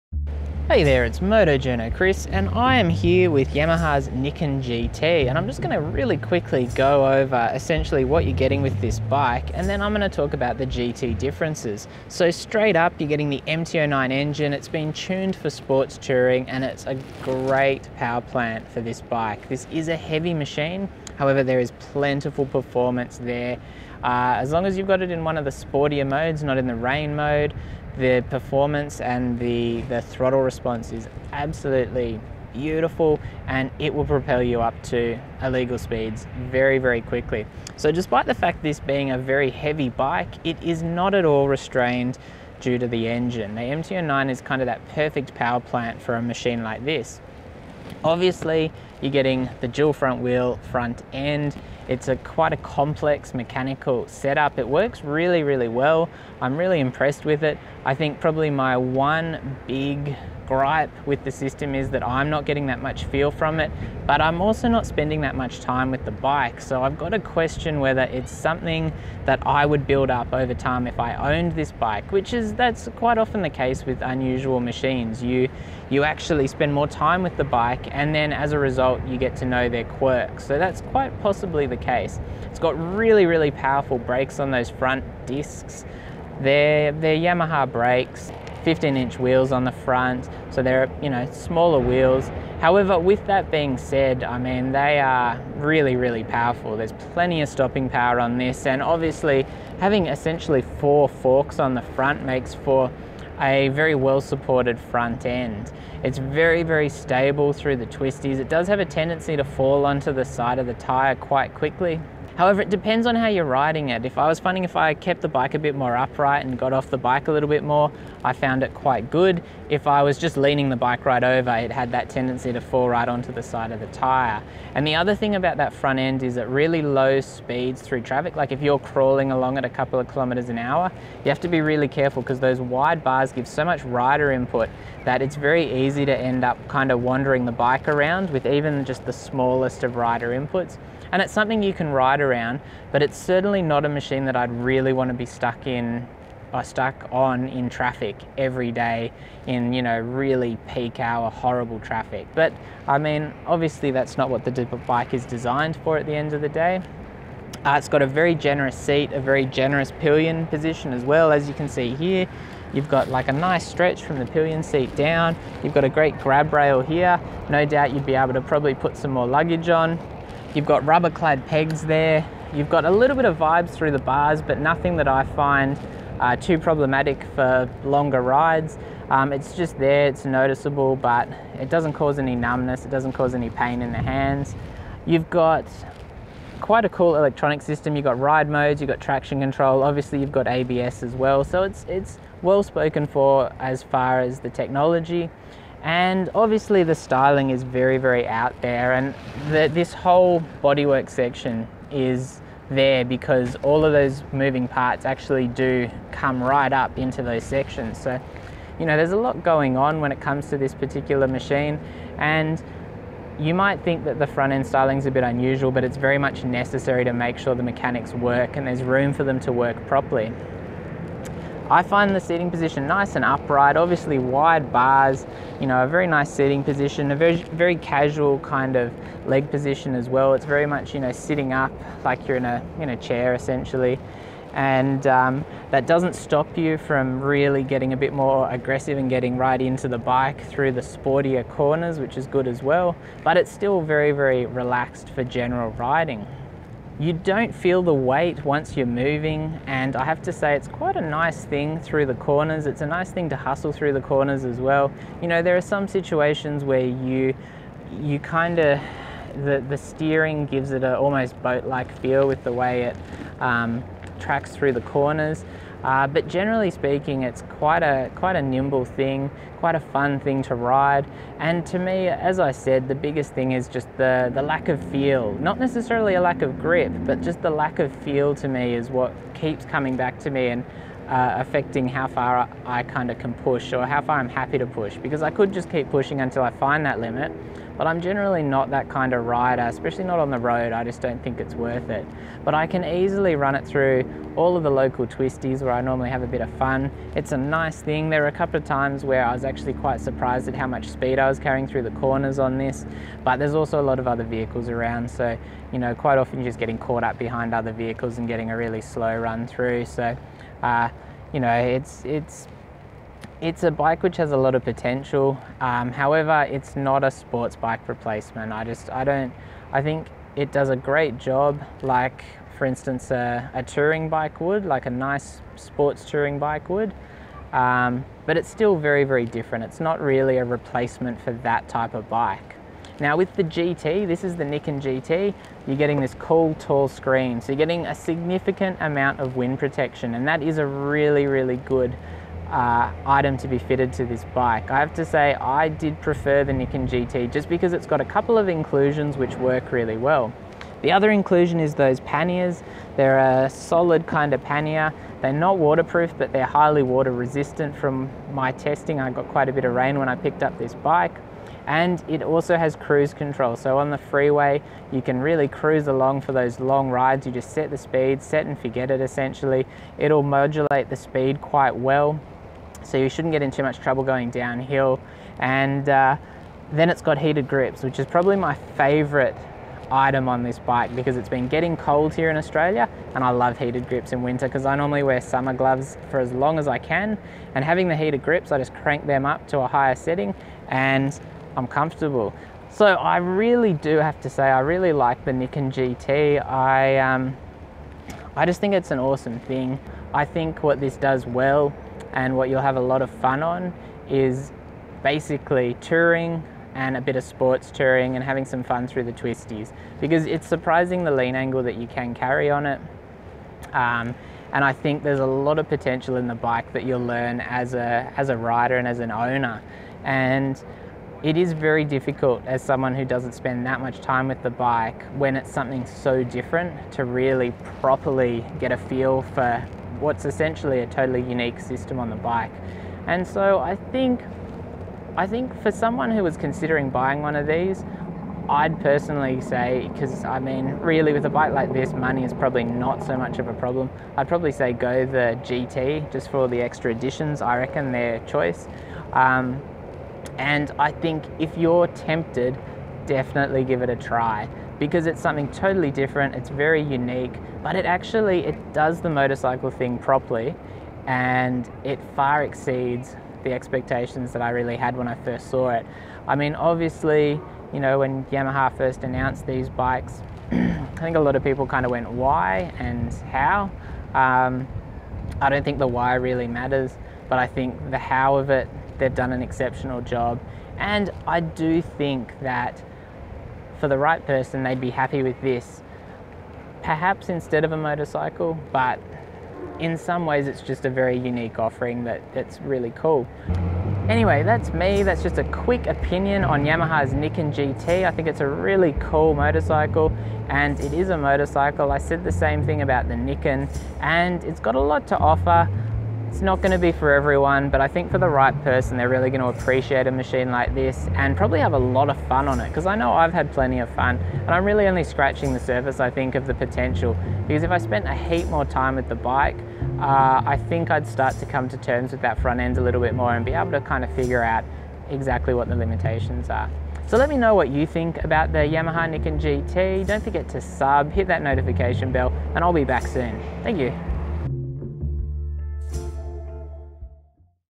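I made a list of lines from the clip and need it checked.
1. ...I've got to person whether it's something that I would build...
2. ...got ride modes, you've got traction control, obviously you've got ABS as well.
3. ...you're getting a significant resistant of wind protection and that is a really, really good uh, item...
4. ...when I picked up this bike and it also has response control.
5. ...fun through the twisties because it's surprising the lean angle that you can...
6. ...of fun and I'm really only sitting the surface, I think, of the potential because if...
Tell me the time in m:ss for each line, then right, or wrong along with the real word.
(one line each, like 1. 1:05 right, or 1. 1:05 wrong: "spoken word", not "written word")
1. 1:06 wrong: "question", not "person"
2. 3:08 right
3. 5:37 wrong: "amount", not "resistant"
4. 5:59 wrong: "cruise", not "response"
5. 6:48 right
6. 8:33 wrong: "scratching", not "sitting".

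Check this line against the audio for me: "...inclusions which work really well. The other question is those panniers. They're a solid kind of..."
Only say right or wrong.
wrong.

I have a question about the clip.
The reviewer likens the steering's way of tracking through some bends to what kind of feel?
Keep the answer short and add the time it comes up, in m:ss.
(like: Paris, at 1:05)
Boat-like, at 4:21.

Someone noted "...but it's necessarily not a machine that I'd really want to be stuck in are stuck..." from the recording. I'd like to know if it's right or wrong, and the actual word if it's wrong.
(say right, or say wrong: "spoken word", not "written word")
wrong: "certainly", not "necessarily".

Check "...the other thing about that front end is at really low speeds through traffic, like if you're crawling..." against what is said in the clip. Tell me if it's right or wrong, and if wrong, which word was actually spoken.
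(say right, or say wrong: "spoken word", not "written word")
right.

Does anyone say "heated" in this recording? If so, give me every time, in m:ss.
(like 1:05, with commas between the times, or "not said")
6:17, 6:23, 6:27.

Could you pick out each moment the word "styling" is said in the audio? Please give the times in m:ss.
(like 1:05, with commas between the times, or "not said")
3:16, 3:34.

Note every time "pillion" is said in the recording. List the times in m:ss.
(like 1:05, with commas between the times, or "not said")
2:39, 2:44.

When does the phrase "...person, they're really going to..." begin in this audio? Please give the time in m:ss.
8:28.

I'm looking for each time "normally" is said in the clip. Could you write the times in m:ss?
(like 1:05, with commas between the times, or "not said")
4:55, 6:24.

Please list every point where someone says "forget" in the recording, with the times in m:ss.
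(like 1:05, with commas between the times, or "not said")
6:08, 8:50.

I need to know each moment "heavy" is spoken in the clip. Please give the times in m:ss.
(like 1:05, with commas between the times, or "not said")
0:19, 0:39.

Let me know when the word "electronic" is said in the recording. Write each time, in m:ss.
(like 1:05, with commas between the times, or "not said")
3:07.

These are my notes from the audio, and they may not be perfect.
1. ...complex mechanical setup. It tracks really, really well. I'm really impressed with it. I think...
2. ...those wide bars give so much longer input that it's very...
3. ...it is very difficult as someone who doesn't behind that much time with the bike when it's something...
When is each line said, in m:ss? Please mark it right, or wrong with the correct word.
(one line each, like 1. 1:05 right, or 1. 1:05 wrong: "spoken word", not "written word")
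1. 0:52 wrong: "works", not "tracks"
2. 2:12 wrong: "rider", not "longer"
3. 7:01 wrong: "spend", not "behind".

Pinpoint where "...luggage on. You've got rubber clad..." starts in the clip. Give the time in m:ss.
2:49.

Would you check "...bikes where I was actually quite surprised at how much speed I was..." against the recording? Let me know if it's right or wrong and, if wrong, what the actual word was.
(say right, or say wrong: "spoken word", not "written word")
wrong: "times", not "bikes".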